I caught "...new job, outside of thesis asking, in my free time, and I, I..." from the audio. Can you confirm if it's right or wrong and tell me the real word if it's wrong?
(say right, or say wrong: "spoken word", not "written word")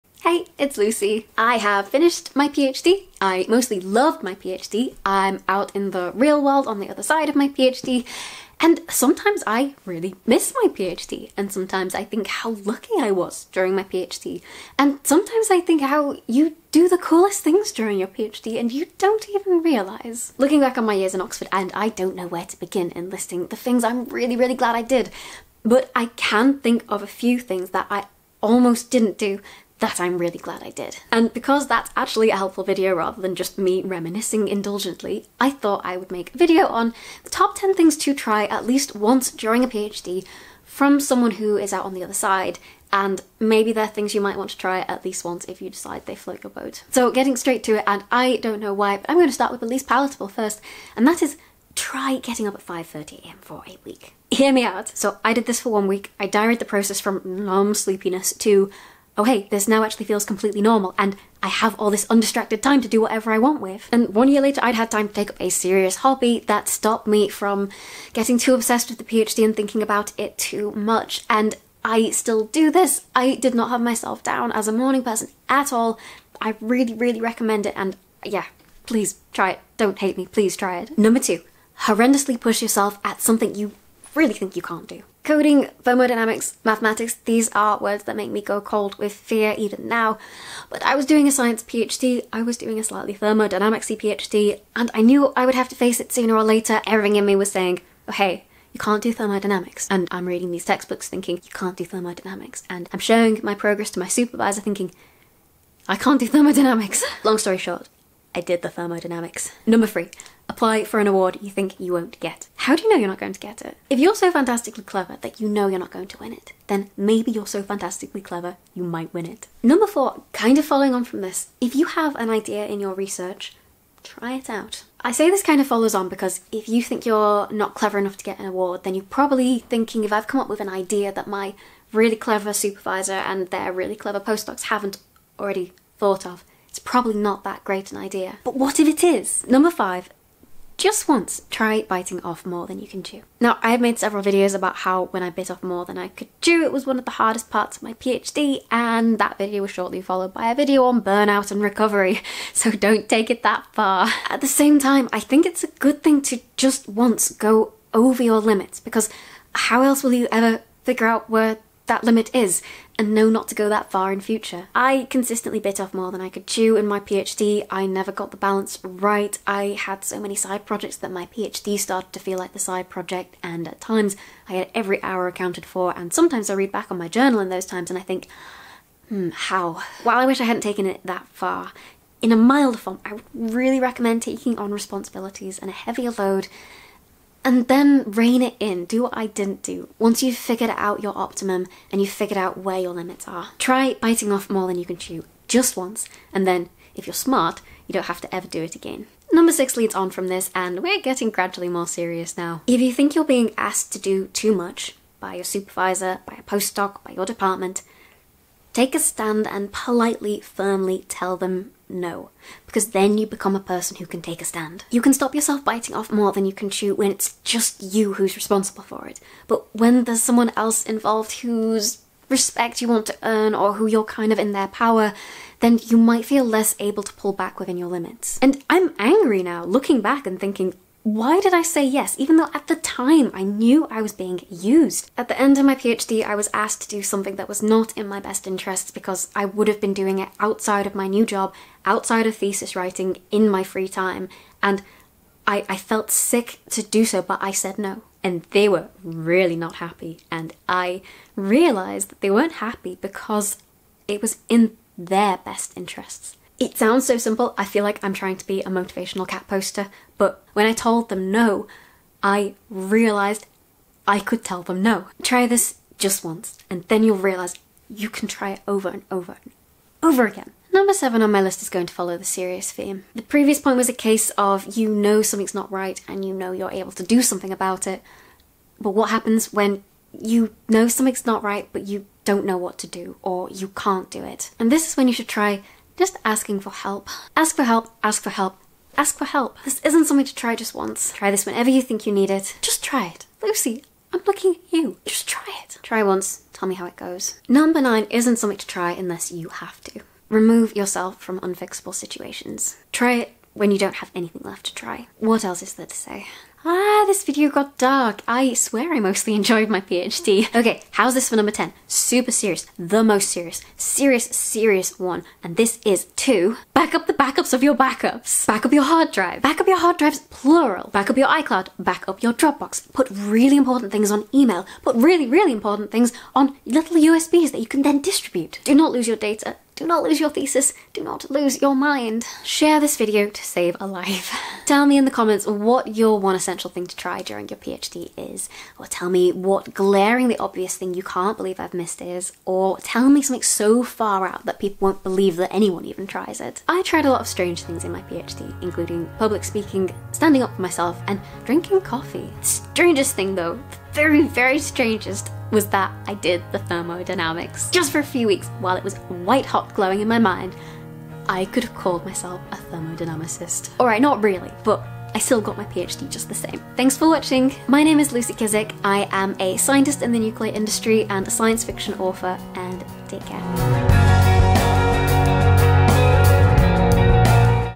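wrong: "writing", not "asking".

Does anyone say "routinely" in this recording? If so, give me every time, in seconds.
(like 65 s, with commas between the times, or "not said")
not said.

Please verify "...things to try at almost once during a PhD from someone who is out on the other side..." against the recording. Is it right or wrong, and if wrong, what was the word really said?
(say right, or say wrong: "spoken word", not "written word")
wrong: "least", not "almost".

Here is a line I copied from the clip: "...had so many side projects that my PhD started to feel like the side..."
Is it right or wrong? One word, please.
right.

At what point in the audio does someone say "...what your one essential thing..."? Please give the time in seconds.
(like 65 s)
335 s.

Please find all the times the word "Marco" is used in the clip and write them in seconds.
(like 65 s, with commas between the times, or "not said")
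not said.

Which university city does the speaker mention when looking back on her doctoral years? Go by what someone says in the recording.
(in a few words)
Oxford.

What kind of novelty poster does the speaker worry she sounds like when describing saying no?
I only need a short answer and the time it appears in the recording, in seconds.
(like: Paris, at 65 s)
Motivational cat poster, at 258 s.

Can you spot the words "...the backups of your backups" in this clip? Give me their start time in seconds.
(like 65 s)
317 s.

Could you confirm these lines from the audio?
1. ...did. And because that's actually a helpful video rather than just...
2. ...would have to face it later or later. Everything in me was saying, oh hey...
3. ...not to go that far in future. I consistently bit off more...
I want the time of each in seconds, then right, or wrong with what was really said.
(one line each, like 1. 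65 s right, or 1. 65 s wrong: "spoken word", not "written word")
1. 30 s right
2. 95 s wrong: "sooner", not "later"
3. 163 s right.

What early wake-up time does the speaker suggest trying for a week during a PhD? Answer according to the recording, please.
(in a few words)
5:30am.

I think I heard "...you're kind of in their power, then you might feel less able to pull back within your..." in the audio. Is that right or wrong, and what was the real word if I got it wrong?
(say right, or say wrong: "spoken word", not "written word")
right.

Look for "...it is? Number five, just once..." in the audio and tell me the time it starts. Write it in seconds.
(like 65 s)
138 s.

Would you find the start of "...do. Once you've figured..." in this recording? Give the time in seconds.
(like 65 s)
189 s.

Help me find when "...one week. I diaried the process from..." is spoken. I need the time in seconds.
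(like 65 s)
55 s.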